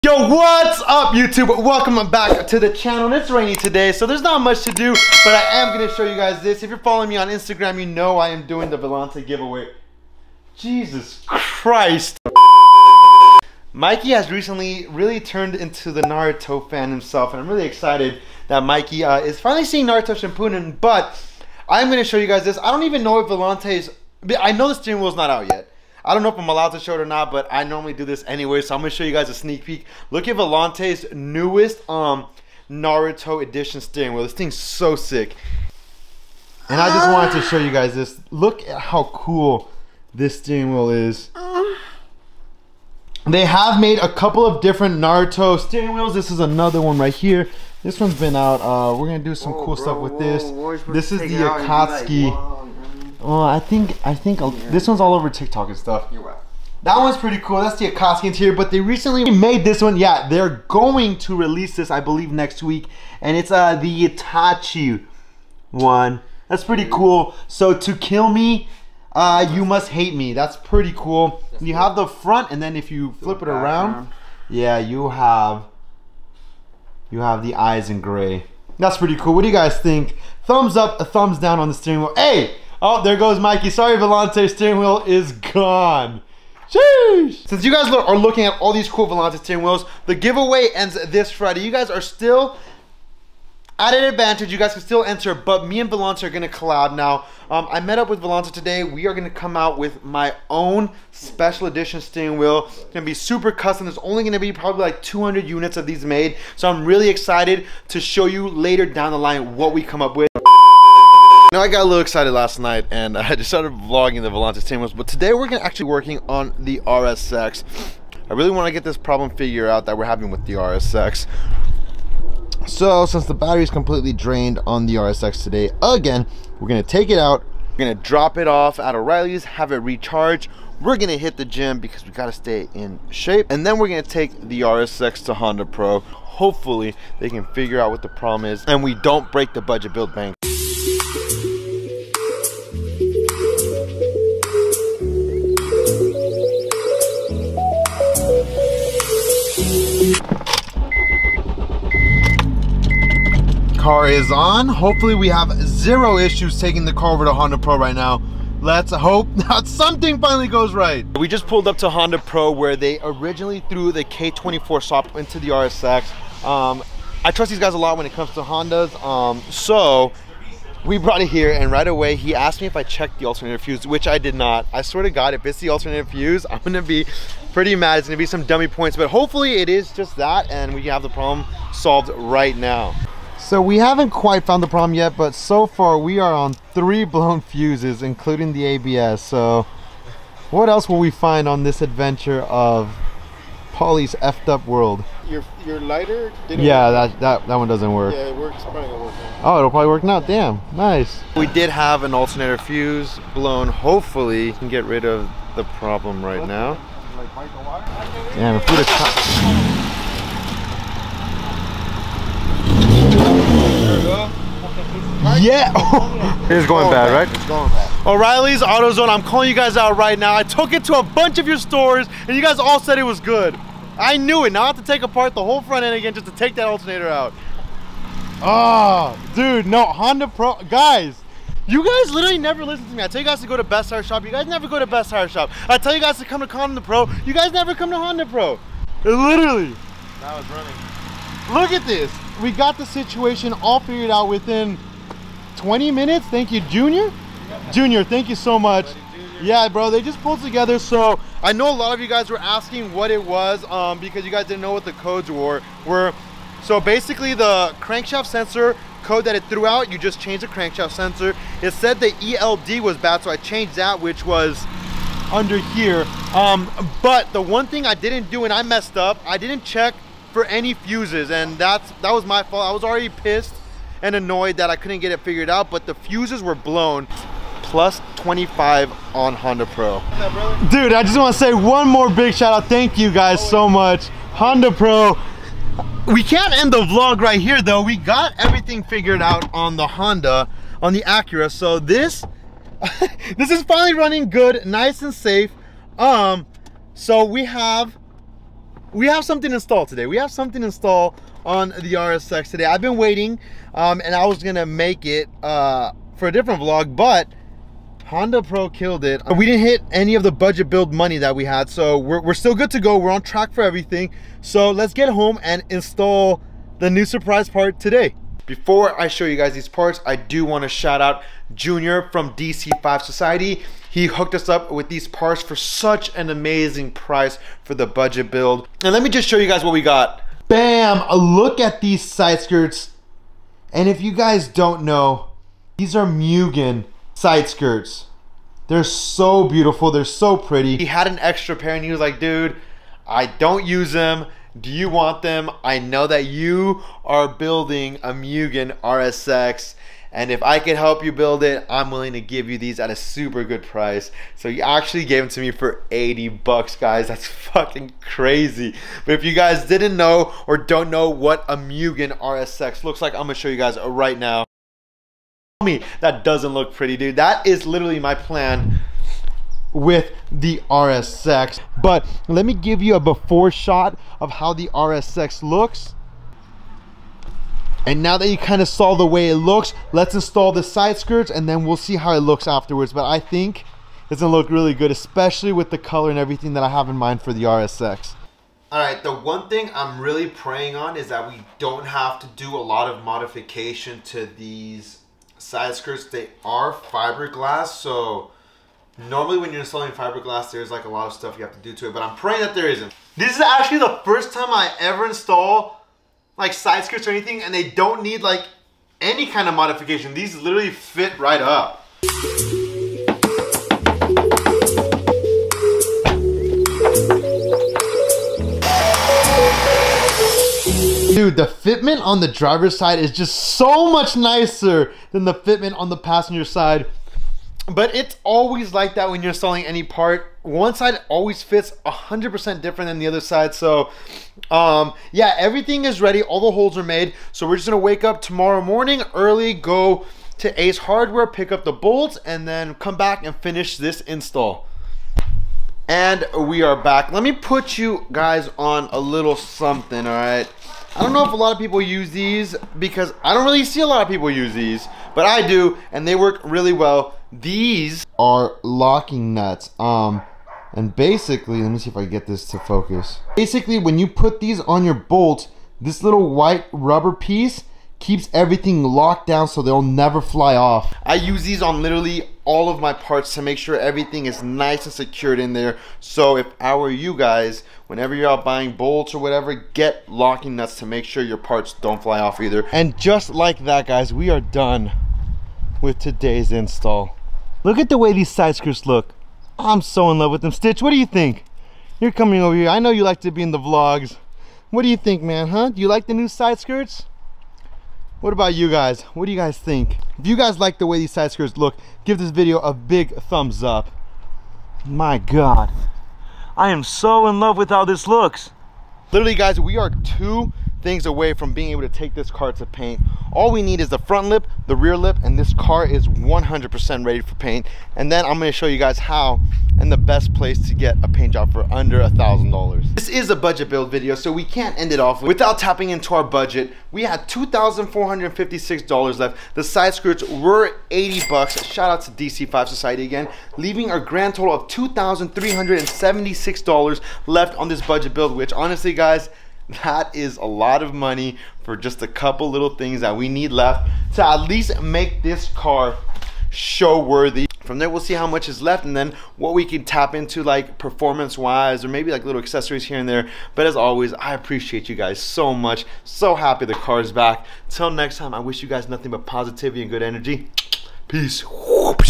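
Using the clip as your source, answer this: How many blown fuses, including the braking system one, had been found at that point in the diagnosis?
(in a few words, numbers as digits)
3.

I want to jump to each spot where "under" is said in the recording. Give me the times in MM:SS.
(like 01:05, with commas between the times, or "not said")
04:25, 08:41.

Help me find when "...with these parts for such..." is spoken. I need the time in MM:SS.
05:24.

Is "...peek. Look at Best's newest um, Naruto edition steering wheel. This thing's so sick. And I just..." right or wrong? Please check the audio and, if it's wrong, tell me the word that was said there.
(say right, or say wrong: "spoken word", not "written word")
wrong: "Volante", not "Best".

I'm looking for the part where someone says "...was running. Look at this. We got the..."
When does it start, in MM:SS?
04:00.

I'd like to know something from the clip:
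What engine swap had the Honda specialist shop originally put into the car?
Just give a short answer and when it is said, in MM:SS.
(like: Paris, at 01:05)
K24, at 02:44.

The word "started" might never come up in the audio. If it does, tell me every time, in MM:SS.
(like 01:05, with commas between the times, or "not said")
01:53.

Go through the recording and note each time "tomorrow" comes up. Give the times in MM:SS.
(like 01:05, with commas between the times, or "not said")
07:18.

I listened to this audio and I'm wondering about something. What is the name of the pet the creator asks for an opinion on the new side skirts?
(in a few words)
Stitch.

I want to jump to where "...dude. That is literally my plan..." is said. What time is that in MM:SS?
06:06.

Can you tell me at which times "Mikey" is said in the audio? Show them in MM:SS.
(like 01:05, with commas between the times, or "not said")
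00:13, 00:18, 01:23.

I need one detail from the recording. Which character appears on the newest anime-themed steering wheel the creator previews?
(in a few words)
Itachi.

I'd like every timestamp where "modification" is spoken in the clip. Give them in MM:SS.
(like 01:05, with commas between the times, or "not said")
06:33, 06:49.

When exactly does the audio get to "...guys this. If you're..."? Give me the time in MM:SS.
00:06.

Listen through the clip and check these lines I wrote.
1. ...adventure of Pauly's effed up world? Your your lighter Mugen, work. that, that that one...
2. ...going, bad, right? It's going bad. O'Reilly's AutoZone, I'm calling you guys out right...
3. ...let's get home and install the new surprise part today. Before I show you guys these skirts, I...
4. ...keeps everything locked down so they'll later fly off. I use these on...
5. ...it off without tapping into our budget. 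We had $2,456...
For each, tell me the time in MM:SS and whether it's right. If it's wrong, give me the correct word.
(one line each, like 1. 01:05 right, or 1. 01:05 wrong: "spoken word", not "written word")
1. 03:11 wrong: "Yeah", not "Mugen"
2. 03:36 right
3. 05:14 wrong: "parts", not "skirts"
4. 07:47 wrong: "never", not "later"
5. 08:44 right.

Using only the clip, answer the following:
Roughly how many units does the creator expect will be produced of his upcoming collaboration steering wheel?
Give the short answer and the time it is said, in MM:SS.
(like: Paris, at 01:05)
200, at 01:45.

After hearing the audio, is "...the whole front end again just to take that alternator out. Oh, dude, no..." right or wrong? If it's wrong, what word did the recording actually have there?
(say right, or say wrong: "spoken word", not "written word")
right.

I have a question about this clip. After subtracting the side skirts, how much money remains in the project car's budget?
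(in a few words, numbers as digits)
$2,376.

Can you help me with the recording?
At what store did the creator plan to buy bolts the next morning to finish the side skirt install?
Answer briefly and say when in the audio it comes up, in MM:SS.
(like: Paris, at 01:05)
Ace Hardware, at 07:20.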